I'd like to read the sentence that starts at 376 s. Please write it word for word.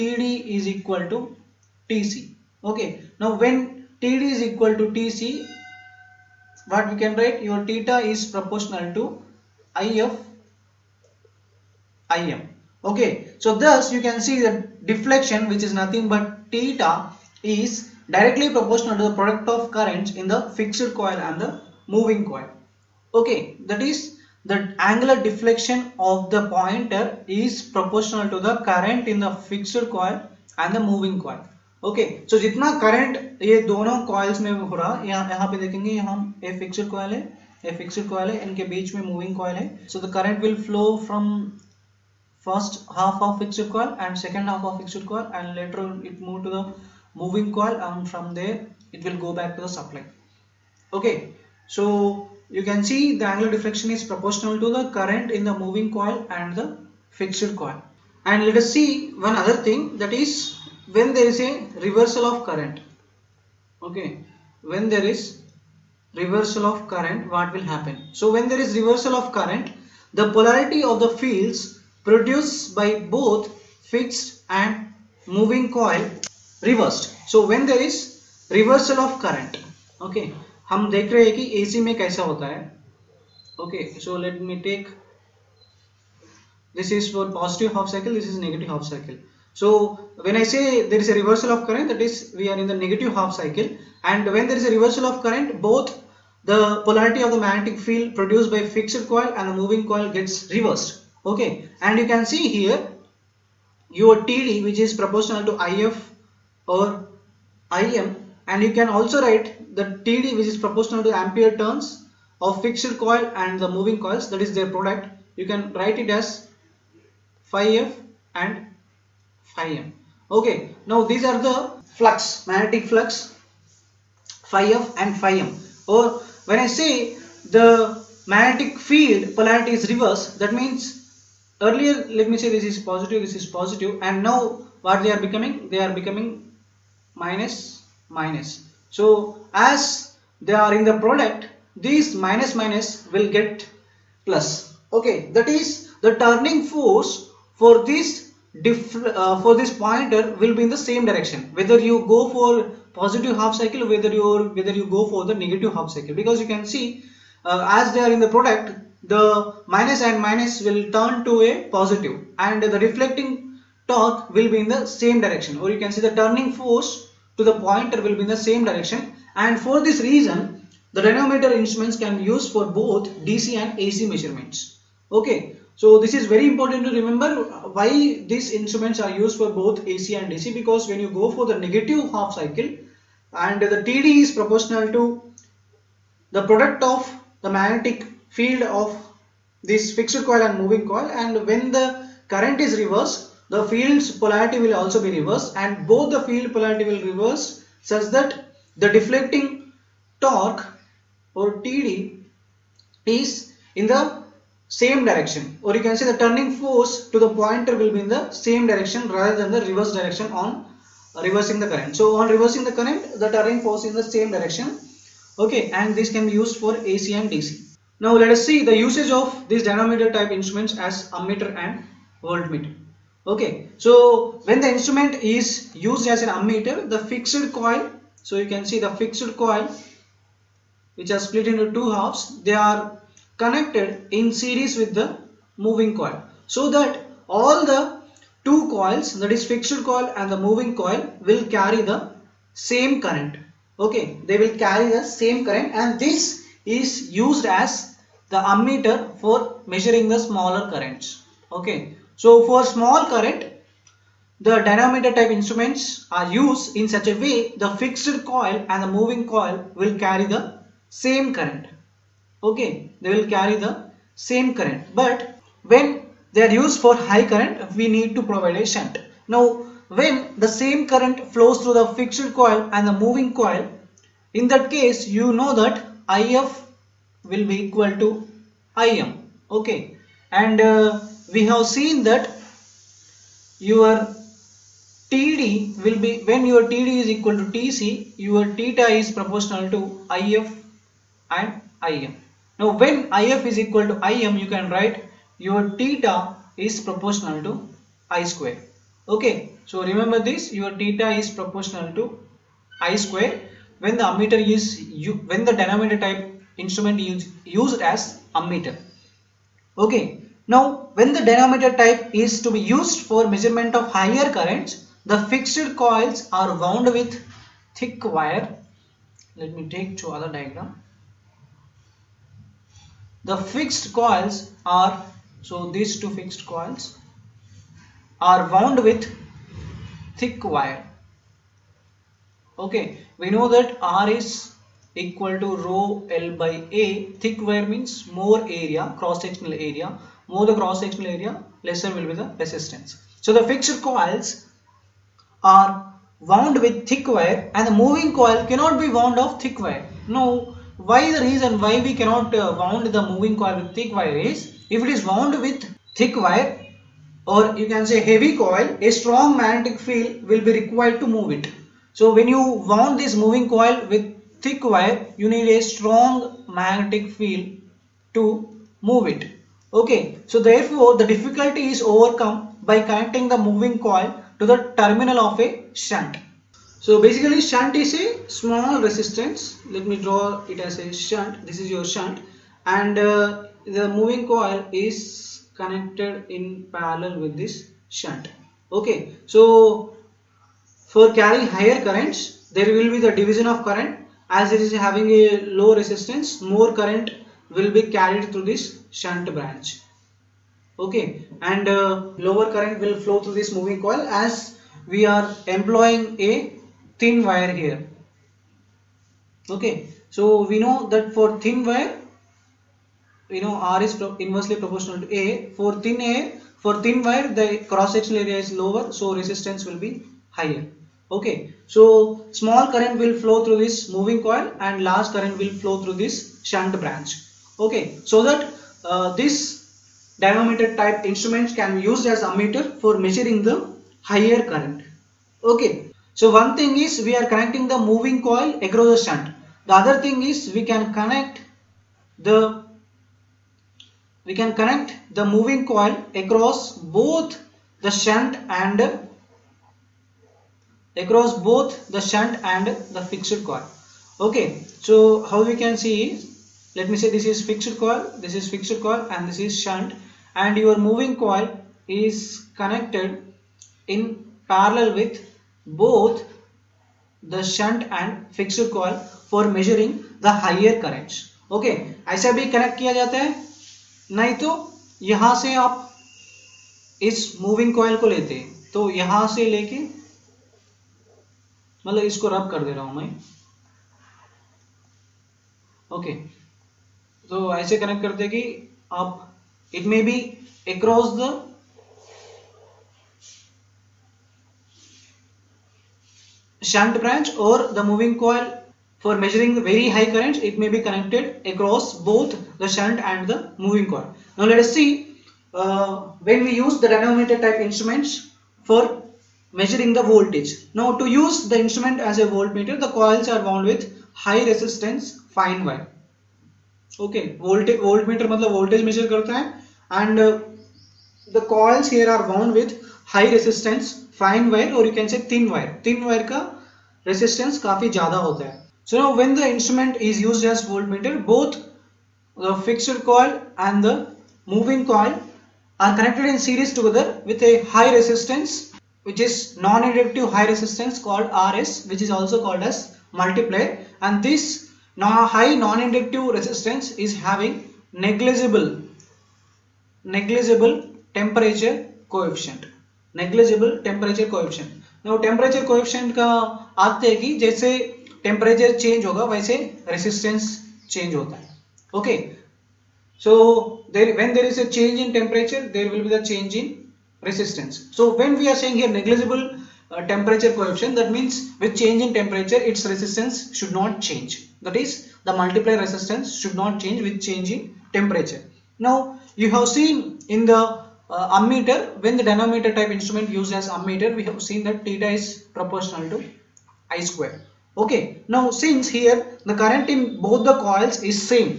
So basically shunt is a small resistance.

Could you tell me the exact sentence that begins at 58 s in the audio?
And let us see one other thing that is when there is a reversal of current.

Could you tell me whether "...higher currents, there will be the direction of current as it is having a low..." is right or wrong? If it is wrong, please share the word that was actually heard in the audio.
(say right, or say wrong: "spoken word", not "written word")
wrong: "division", not "direction".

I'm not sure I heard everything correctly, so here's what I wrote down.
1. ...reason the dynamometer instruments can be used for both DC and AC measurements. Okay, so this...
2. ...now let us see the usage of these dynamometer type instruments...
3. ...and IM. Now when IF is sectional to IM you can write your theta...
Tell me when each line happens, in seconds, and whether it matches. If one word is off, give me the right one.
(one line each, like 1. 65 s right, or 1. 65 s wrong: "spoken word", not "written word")
1. 170 s right
2. 217 s right
3. 291 s wrong: "equal", not "sectional".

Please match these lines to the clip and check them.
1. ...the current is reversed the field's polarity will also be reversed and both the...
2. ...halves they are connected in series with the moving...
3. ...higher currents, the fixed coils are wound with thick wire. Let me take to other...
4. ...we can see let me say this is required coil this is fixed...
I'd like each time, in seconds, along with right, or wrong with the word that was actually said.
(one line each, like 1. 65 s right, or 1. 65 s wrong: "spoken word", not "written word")
1. 191 s right
2. 231 s right
3. 313 s right
4. 455 s wrong: "fixed", not "required".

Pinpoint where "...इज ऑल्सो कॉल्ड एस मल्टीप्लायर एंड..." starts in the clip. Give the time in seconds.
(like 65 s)
542 s.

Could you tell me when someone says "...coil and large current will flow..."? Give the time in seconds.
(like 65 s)
424 s.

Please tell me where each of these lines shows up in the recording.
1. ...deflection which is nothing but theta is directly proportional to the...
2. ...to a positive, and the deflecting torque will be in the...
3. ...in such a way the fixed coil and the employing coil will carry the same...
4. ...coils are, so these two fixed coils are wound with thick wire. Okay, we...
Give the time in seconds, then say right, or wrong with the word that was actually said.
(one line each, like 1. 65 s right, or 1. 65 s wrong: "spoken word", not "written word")
1. 14 s right
2. 161 s right
3. 256 s wrong: "moving", not "employing"
4. 323 s right.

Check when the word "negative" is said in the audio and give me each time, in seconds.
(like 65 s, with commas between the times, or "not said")
88 s, 92 s, 155 s, 181 s.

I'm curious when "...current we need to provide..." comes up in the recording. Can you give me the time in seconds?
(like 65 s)
267 s.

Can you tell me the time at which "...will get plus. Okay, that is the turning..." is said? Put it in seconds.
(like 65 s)
143 s.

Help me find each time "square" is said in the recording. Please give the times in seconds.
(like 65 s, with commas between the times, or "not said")
298 s, 302 s, 587 s.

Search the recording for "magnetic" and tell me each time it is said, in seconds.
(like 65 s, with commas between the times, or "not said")
97 s, 122 s, 128 s, 187 s, 359 s, 366 s.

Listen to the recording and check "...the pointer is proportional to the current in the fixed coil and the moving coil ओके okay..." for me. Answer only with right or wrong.
right.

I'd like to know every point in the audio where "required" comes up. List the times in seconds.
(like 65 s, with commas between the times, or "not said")
360 s.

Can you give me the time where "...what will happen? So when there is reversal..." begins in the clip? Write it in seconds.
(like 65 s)
67 s.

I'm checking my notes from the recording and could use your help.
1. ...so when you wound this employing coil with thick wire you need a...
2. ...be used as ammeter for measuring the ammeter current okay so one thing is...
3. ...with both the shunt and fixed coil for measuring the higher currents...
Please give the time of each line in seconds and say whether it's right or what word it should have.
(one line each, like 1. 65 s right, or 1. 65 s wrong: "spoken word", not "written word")
1. 361 s wrong: "moving", not "employing"
2. 431 s wrong: "higher", not "ammeter"
3. 465 s right.